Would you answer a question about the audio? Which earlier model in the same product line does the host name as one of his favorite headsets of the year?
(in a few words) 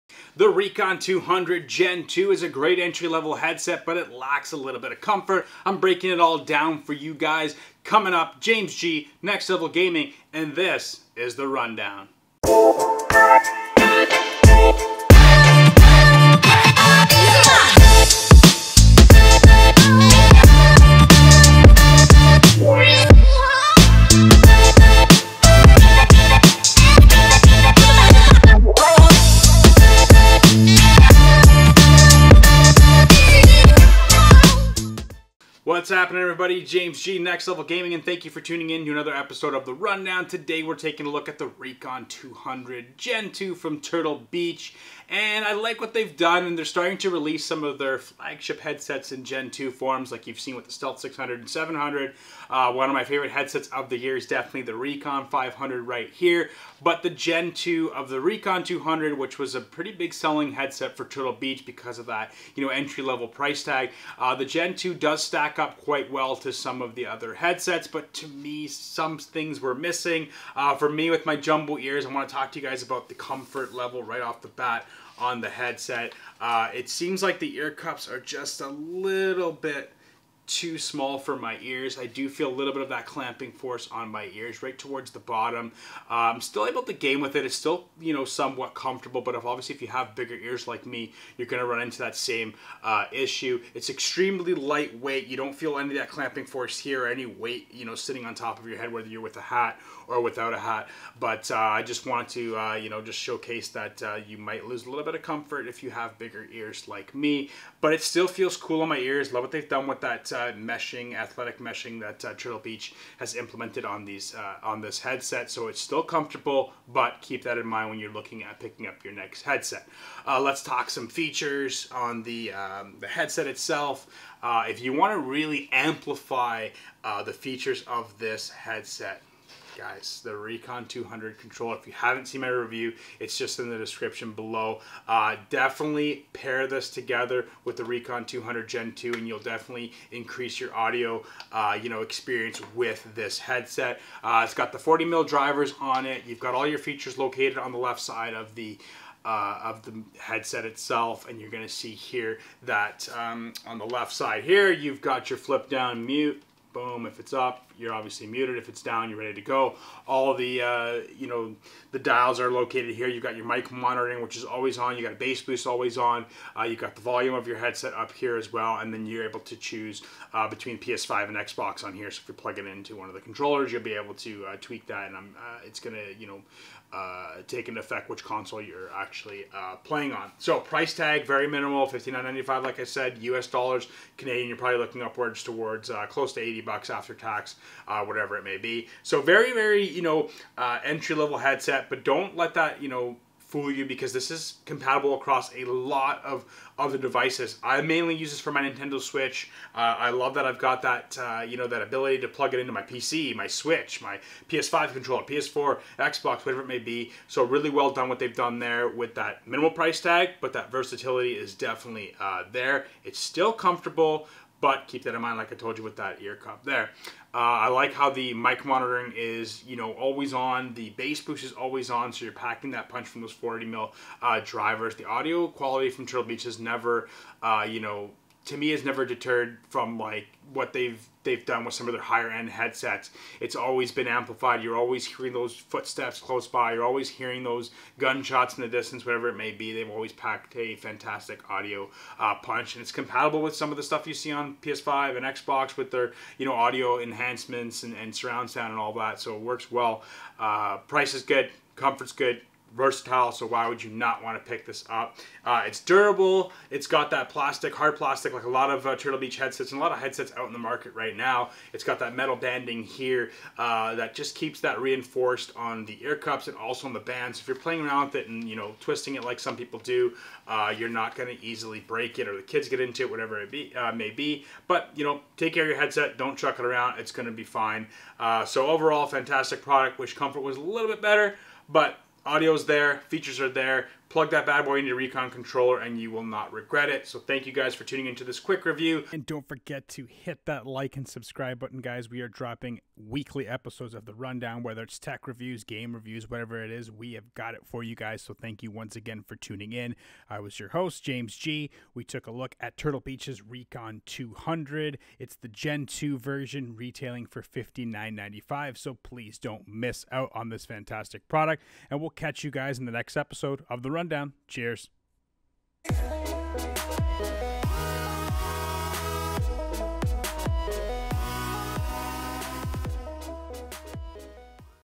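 Recon 500.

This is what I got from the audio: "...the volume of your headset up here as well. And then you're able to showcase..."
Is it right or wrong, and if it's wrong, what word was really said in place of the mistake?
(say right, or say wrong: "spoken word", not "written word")
wrong: "choose", not "showcase".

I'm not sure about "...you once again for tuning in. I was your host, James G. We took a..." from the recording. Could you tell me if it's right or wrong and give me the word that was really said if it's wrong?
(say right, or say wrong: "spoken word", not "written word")
right.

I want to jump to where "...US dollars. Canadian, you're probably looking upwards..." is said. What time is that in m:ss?
3:03.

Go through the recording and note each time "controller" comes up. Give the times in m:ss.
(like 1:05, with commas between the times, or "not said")
2:11, 2:53, 3:24, 4:45.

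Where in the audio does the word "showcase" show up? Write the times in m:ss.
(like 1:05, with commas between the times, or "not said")
1:43.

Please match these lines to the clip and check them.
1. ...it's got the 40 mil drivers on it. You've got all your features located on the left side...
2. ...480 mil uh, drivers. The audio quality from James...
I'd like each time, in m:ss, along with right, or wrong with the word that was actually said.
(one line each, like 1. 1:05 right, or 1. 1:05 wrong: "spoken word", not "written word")
1. 2:24 right
2. 3:43 wrong: "Turtle", not "James".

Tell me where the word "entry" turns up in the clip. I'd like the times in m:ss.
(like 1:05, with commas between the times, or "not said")
0:02, 1:02, 3:10.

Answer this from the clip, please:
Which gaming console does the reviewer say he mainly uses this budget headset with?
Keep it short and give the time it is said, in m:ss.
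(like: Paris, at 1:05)
Nintendo Switch, at 3:18.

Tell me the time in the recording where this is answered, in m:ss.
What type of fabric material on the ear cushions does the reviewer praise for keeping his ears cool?
1:51.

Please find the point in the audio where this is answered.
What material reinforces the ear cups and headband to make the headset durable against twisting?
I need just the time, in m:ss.
4:22.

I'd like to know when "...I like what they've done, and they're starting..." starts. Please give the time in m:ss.
0:45.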